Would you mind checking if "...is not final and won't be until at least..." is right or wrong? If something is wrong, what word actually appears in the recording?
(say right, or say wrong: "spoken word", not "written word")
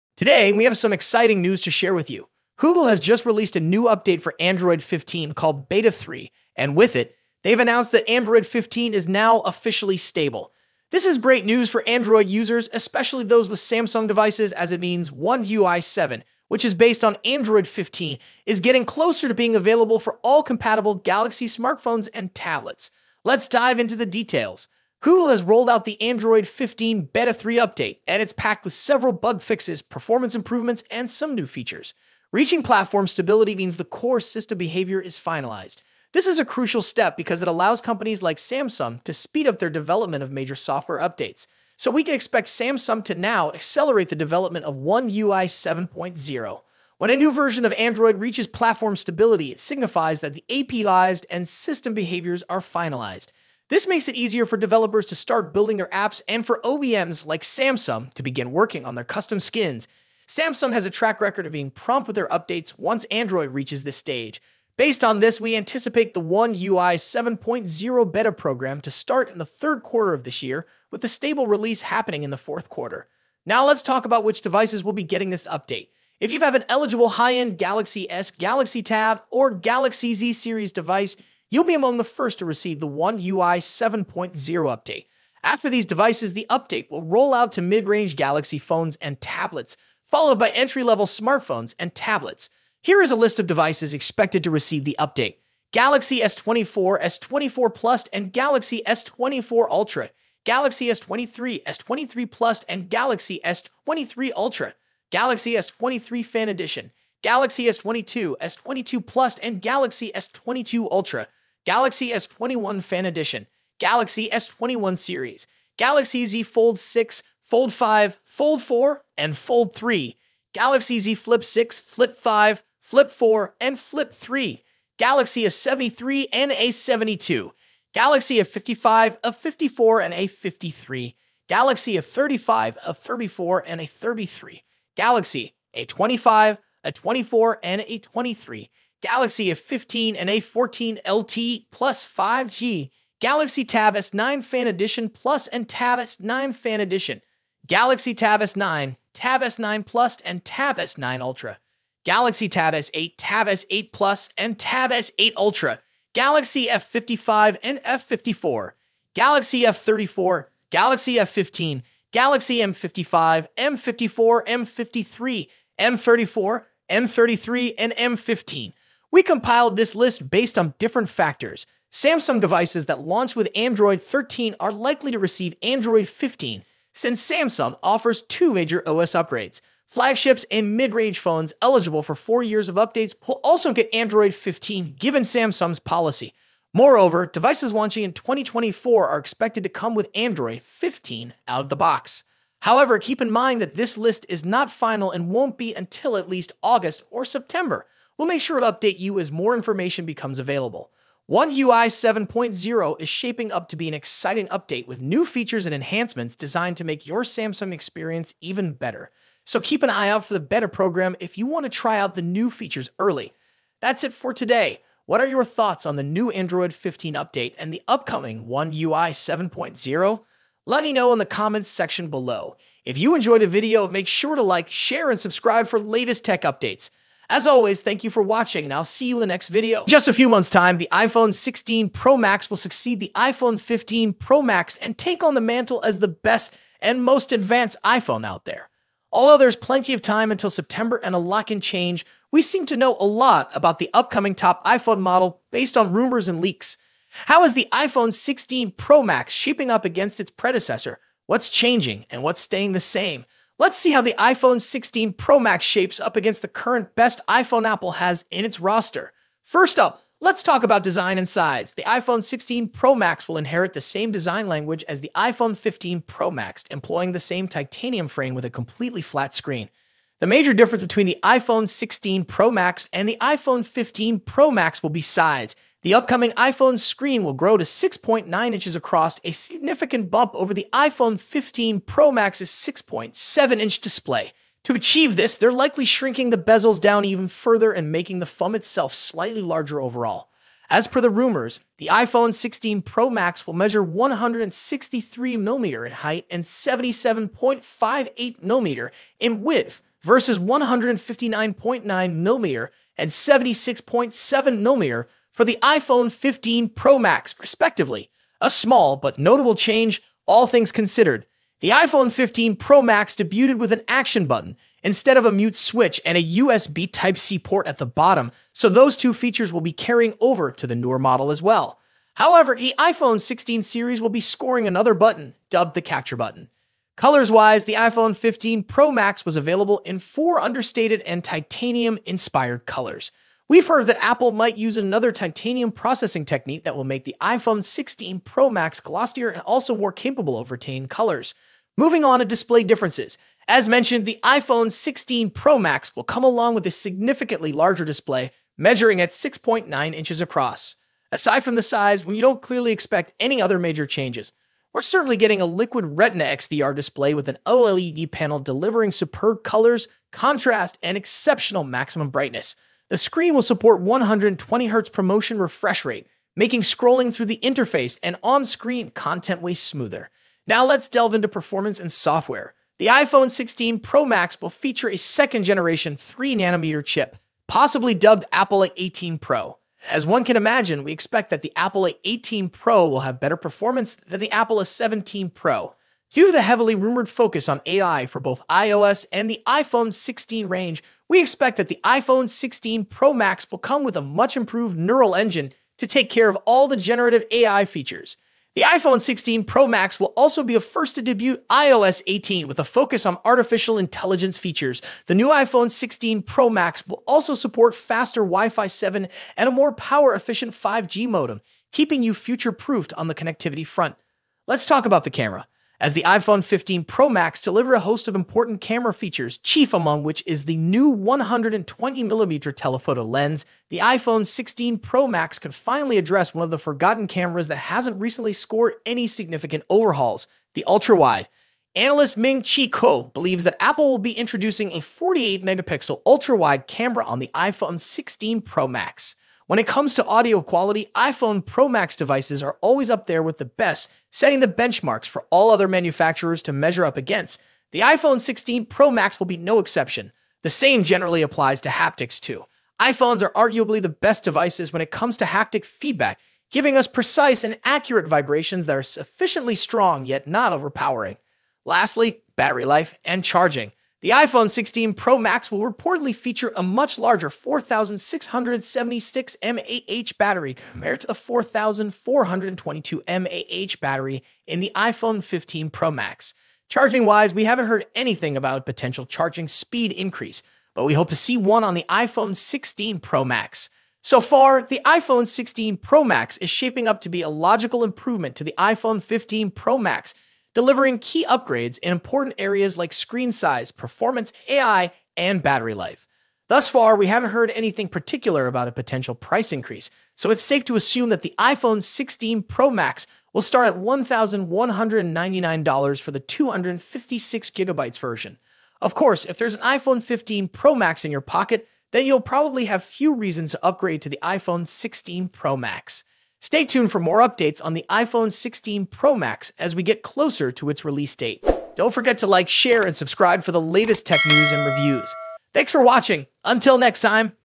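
right.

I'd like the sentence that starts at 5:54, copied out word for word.
We're certainly getting a liquid retina XDR display with an OLED panel delivering superb colors, contrast, and exceptional maximum brightness.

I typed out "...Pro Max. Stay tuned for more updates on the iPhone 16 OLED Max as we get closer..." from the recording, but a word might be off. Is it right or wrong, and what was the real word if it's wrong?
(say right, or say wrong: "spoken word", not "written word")
wrong: "Pro", not "OLED".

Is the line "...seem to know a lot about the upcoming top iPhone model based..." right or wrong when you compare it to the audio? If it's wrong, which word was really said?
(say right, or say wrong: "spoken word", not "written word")
right.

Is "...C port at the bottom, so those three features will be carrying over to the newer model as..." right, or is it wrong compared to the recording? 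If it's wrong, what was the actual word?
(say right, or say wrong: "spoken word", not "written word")
wrong: "two", not "three".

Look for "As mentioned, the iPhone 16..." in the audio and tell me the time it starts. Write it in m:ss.
5:43.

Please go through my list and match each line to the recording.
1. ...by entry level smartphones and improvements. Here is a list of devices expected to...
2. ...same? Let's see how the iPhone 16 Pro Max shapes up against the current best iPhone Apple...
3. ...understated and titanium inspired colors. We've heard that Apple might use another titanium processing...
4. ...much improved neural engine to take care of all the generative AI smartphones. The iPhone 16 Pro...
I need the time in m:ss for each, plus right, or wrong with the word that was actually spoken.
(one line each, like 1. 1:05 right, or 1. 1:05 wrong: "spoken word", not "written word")
1. 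1:30 wrong: "tablets", not "improvements"
2. 4:12 right
3. 5:30 right
4. 6:34 wrong: "features", not "smartphones".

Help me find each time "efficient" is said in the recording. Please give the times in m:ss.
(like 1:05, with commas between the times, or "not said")
6:50.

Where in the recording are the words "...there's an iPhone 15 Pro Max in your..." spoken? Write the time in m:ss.
8:29.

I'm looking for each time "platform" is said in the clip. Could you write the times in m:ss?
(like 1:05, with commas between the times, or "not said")
0:32, 0:48.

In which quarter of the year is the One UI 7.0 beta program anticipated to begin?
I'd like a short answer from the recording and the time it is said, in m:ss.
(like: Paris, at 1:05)
third quarter, at 1:09.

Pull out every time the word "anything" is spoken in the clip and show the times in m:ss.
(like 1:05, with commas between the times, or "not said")
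7:57, 8:17.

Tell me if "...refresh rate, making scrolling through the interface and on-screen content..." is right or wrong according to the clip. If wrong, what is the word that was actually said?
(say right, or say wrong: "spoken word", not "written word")
right.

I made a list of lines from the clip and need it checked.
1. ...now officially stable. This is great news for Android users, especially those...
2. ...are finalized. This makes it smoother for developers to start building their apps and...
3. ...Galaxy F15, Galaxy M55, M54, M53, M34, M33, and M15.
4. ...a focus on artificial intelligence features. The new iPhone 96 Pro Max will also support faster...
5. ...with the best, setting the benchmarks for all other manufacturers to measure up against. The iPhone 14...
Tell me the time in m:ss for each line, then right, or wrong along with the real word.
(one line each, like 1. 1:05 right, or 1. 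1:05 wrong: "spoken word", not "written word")
1. 0:09 right
2. 0:52 wrong: "easier", not "smoother"
3. 2:40 right
4. 6:42 wrong: "16", not "96"
5. 7:23 wrong: "16", not "14".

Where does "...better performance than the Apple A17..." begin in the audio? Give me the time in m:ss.
6:23.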